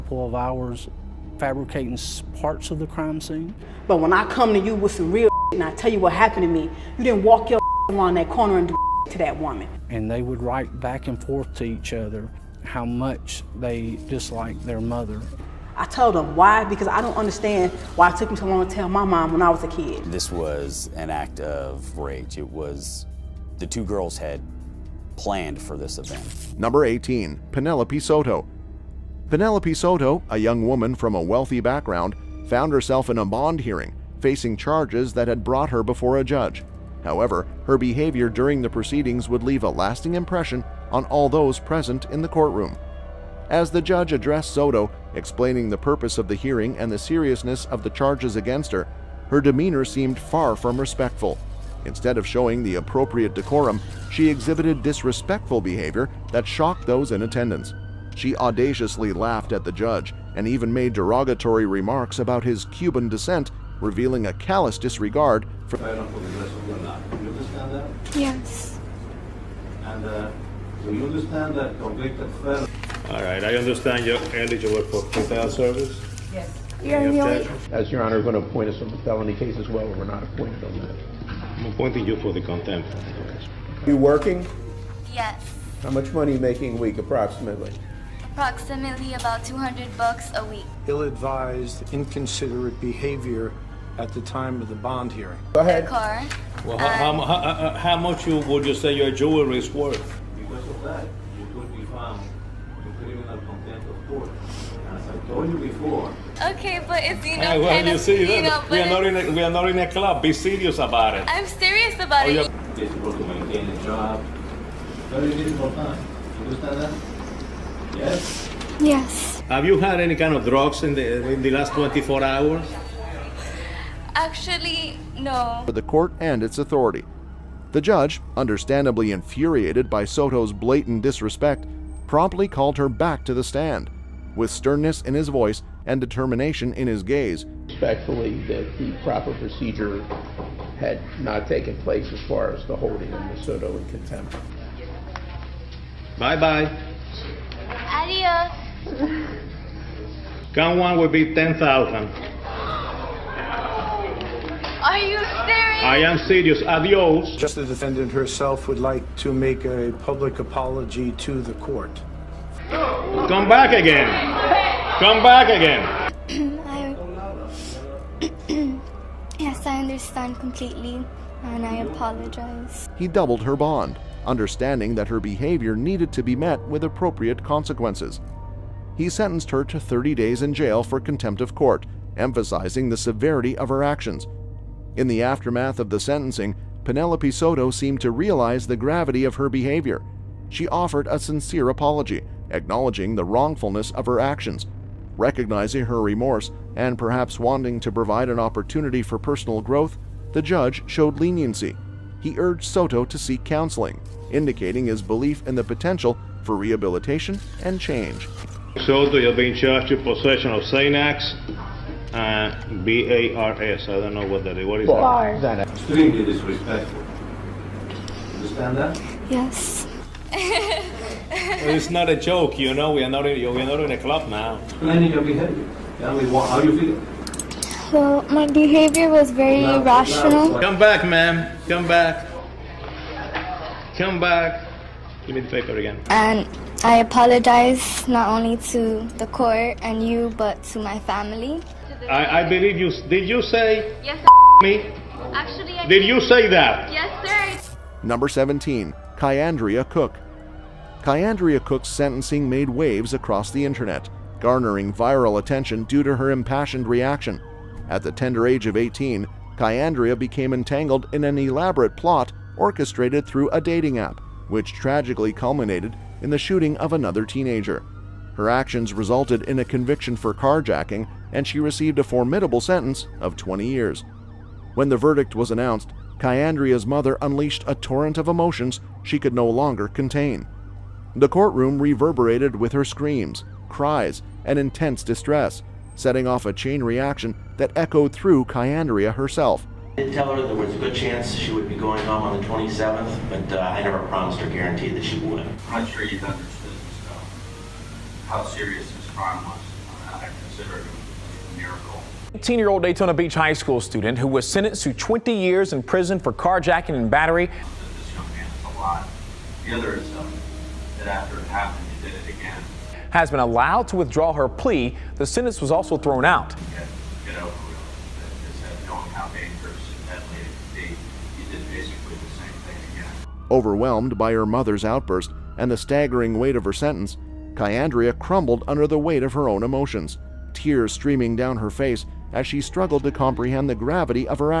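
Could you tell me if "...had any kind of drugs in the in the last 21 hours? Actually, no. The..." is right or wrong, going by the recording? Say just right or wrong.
wrong.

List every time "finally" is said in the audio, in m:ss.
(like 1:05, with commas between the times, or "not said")
not said.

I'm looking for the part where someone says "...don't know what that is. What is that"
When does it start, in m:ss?
3:34.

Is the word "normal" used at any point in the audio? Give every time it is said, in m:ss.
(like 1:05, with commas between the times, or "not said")
not said.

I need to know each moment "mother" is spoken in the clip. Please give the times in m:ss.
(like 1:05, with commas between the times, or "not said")
0:14, 4:36, 5:24.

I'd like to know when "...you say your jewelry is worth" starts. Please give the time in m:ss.
1:38.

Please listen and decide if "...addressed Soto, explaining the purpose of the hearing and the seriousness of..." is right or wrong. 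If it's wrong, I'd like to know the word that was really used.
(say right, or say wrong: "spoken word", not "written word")
right.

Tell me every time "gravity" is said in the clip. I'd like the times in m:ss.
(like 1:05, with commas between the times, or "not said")
3:08, 5:33.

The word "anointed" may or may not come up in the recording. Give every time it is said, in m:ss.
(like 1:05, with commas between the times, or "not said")
not said.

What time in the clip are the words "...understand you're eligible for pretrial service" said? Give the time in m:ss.
1:13.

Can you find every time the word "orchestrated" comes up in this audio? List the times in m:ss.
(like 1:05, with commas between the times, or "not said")
4:22.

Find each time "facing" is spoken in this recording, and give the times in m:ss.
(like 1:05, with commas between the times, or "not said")
0:34.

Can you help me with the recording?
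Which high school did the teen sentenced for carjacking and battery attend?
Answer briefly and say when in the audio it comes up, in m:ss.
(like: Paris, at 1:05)
Daytona Beach High School, at 5:02.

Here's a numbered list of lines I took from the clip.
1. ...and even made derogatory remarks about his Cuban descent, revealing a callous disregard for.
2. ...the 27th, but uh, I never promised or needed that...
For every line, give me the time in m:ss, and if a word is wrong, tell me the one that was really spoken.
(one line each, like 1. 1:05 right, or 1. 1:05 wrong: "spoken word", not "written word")
1. 1:00 right
2. 4:52 wrong: "guaranteed", not "needed".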